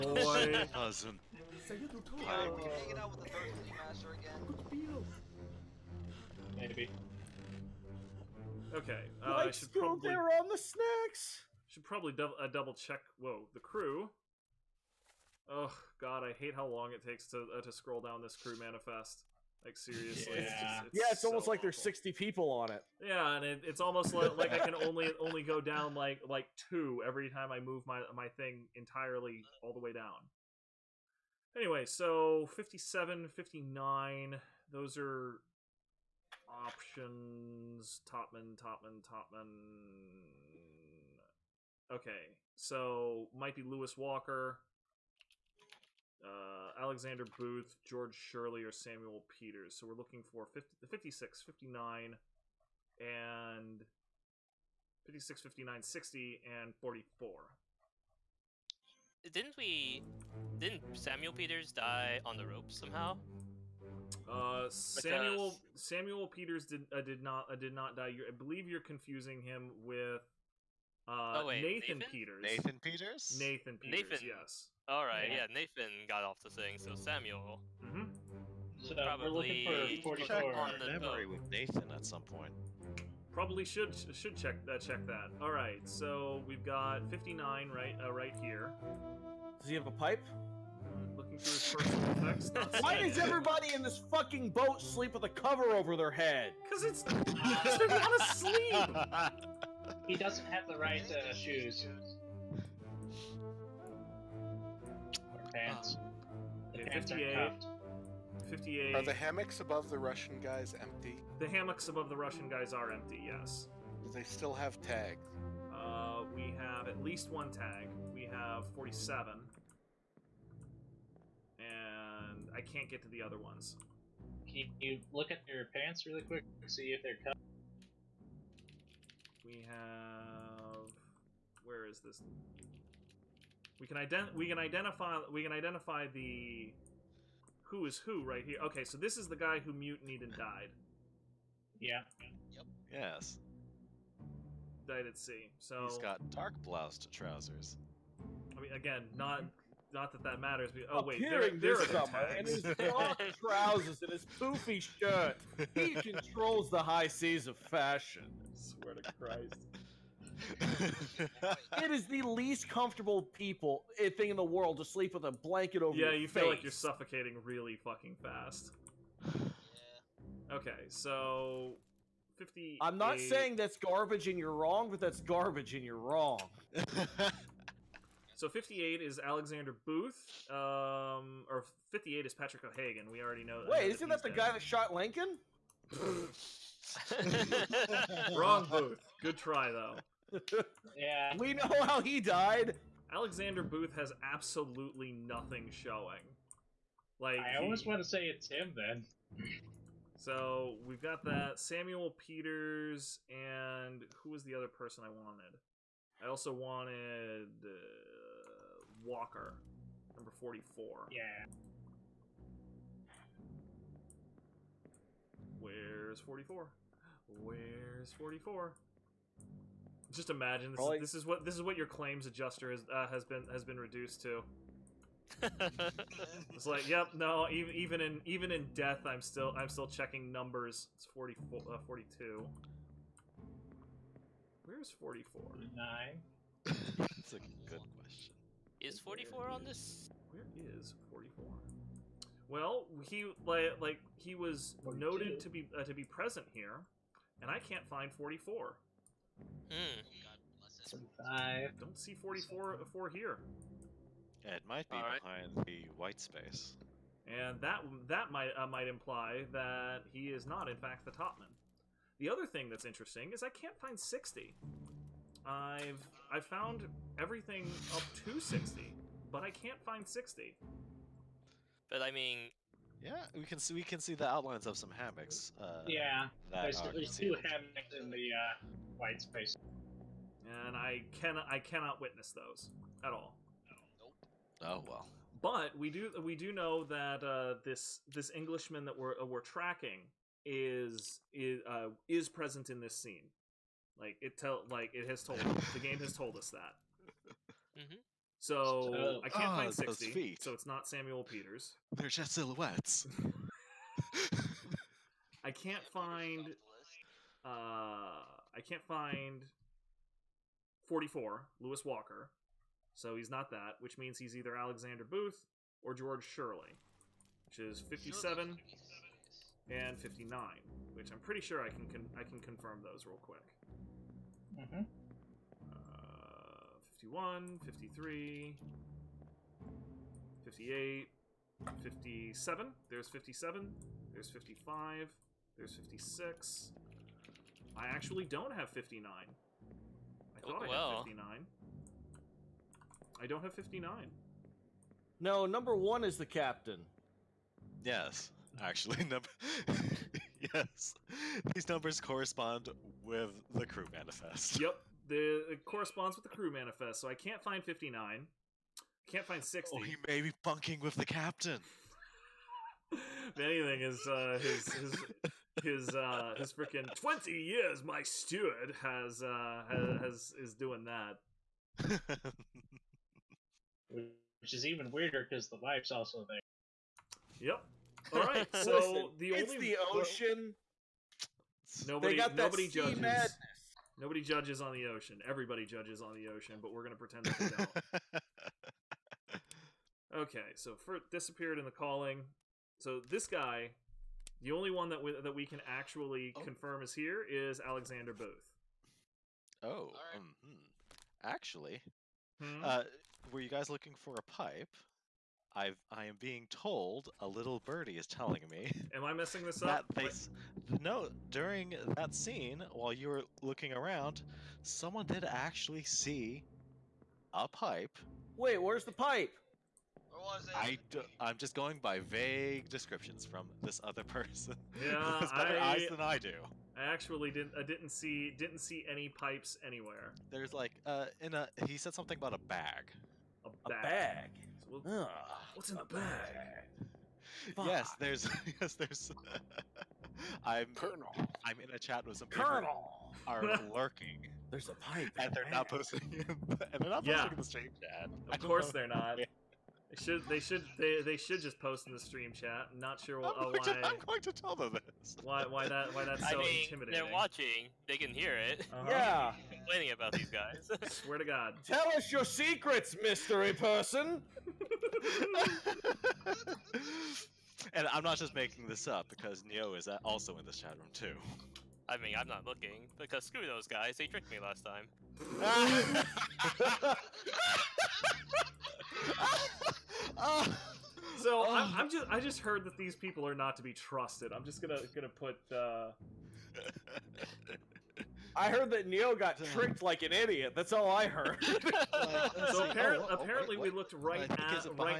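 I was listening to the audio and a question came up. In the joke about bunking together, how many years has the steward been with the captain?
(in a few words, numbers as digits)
20.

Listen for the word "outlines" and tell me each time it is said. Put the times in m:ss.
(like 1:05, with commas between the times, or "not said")
4:34.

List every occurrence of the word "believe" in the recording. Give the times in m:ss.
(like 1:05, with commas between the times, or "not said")
1:08.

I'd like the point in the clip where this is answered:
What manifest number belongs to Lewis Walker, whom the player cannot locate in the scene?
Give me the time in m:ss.
3:30.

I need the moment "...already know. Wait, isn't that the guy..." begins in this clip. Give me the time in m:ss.
3:03.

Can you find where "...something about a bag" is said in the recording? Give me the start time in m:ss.
7:11.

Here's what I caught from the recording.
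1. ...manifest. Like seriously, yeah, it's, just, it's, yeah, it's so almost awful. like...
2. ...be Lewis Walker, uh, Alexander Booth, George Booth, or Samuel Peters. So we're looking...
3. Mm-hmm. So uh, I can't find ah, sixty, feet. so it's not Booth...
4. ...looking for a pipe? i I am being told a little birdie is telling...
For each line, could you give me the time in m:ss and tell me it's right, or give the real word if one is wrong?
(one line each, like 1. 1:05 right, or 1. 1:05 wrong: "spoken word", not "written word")
1. 0:18 right
2. 0:43 wrong: "Shirley", not "Booth"
3. 4:57 wrong: "Samuel", not "Booth"
4. 6:43 right.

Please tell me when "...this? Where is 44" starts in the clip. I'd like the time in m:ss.
3:59.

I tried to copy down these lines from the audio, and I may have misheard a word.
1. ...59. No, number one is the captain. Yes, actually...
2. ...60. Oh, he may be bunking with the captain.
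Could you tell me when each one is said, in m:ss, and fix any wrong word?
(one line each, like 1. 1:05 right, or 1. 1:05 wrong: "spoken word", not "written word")
1. 5:43 right
2. 5:59 right.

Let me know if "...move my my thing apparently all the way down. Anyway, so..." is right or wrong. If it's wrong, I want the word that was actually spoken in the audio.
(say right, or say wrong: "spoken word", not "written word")
wrong: "entirely", not "apparently".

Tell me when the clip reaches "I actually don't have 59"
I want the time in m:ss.
5:37.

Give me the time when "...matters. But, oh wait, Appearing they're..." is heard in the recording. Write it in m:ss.
2:30.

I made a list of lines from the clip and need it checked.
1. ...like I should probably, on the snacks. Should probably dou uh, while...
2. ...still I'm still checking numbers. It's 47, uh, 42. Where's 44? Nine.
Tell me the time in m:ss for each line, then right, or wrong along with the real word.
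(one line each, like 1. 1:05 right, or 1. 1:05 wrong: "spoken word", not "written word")
1. 0:09 wrong: "double", not "while"
2. 3:49 wrong: "44", not "47".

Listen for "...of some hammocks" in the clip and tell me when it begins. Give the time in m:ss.
4:34.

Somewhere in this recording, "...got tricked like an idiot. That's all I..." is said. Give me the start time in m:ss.
8:09.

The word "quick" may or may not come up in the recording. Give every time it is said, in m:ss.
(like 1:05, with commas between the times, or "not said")
2:06, 5:23.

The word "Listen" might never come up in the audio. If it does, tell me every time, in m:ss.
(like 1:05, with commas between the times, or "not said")
6:18.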